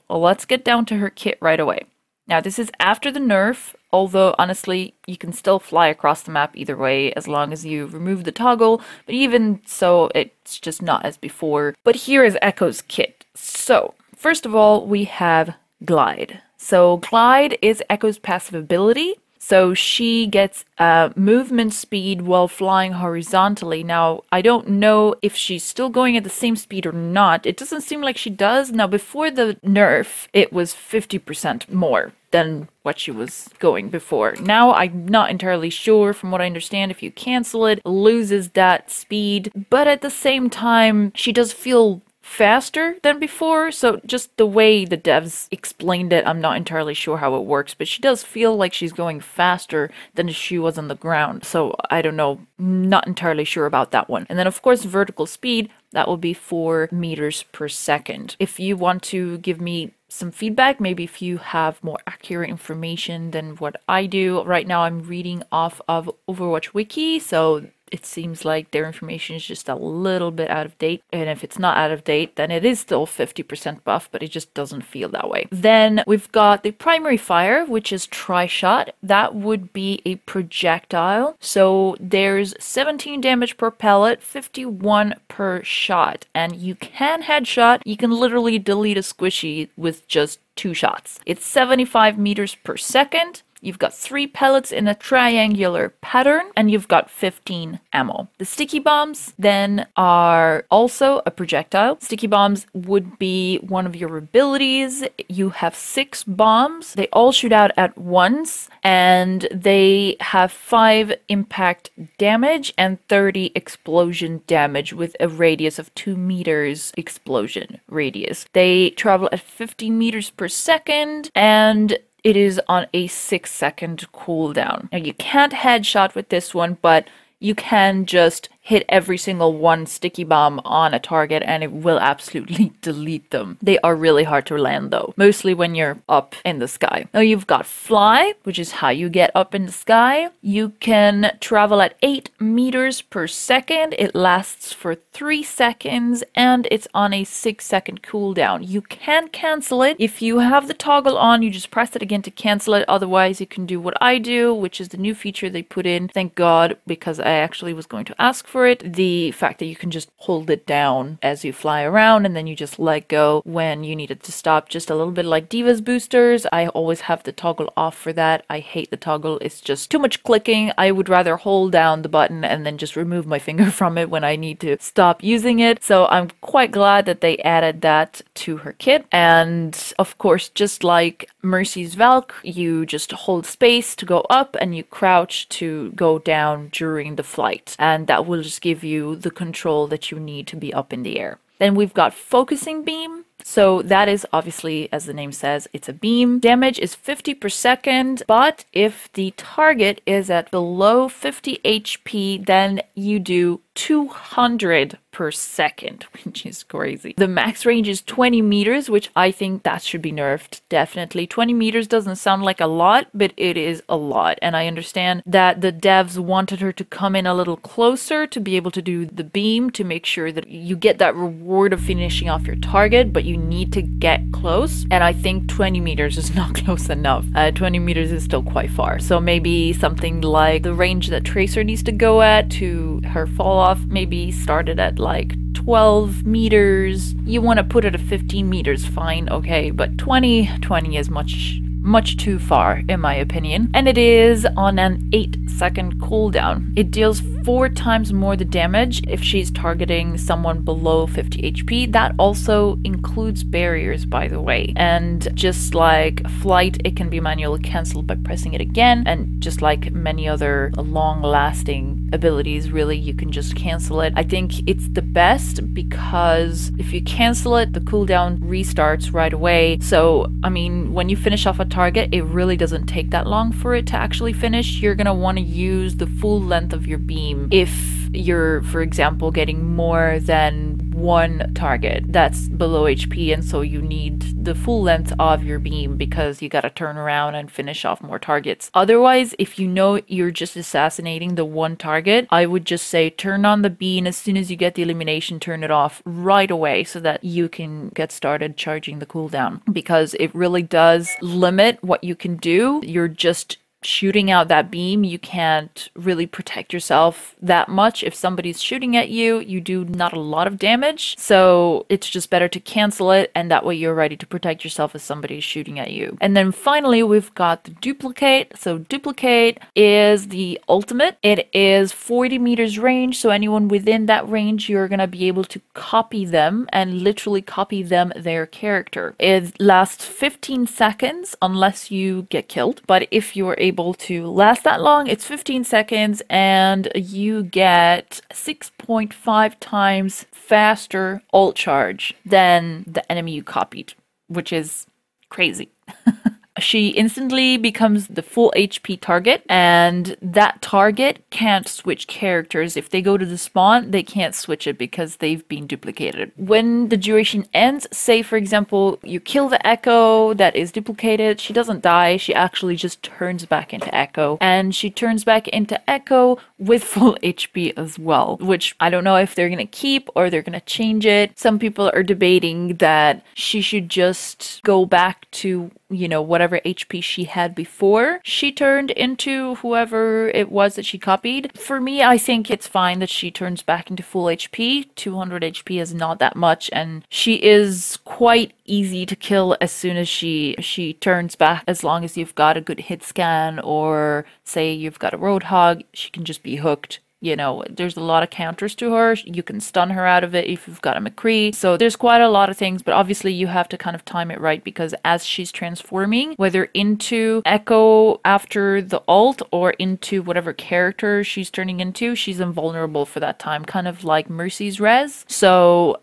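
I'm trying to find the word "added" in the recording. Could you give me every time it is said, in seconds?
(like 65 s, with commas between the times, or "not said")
177 s.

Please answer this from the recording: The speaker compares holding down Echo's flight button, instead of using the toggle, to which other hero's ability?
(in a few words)
D.Va's boosters.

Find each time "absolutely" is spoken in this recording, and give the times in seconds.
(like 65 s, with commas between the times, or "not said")
131 s.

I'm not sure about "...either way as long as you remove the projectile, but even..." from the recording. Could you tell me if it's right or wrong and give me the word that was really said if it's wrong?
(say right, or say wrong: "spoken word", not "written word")
wrong: "toggle", not "projectile".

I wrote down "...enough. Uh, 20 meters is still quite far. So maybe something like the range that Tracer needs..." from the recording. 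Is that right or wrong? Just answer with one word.
right.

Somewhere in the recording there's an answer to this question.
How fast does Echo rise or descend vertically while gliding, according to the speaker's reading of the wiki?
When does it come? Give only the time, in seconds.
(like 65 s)
56 s.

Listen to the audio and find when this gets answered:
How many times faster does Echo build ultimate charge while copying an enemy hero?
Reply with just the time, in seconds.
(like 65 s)
338 s.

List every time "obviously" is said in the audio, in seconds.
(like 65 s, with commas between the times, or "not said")
194 s, 402 s.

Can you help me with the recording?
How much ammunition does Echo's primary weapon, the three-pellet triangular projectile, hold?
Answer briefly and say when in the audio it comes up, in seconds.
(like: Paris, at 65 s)
15, at 97 s.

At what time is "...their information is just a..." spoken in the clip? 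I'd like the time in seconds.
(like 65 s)
68 s.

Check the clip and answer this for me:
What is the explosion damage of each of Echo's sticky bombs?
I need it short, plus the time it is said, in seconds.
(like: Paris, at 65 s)
30, at 113 s.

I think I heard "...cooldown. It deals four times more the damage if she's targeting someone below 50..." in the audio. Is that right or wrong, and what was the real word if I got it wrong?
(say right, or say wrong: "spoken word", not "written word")
right.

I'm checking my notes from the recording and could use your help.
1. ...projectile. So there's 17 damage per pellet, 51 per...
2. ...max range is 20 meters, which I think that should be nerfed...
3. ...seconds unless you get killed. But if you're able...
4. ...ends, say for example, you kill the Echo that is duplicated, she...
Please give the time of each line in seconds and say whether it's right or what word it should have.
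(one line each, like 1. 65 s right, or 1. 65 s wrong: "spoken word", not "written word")
1. 80 s right
2. 207 s right
3. 330 s right
4. 357 s right.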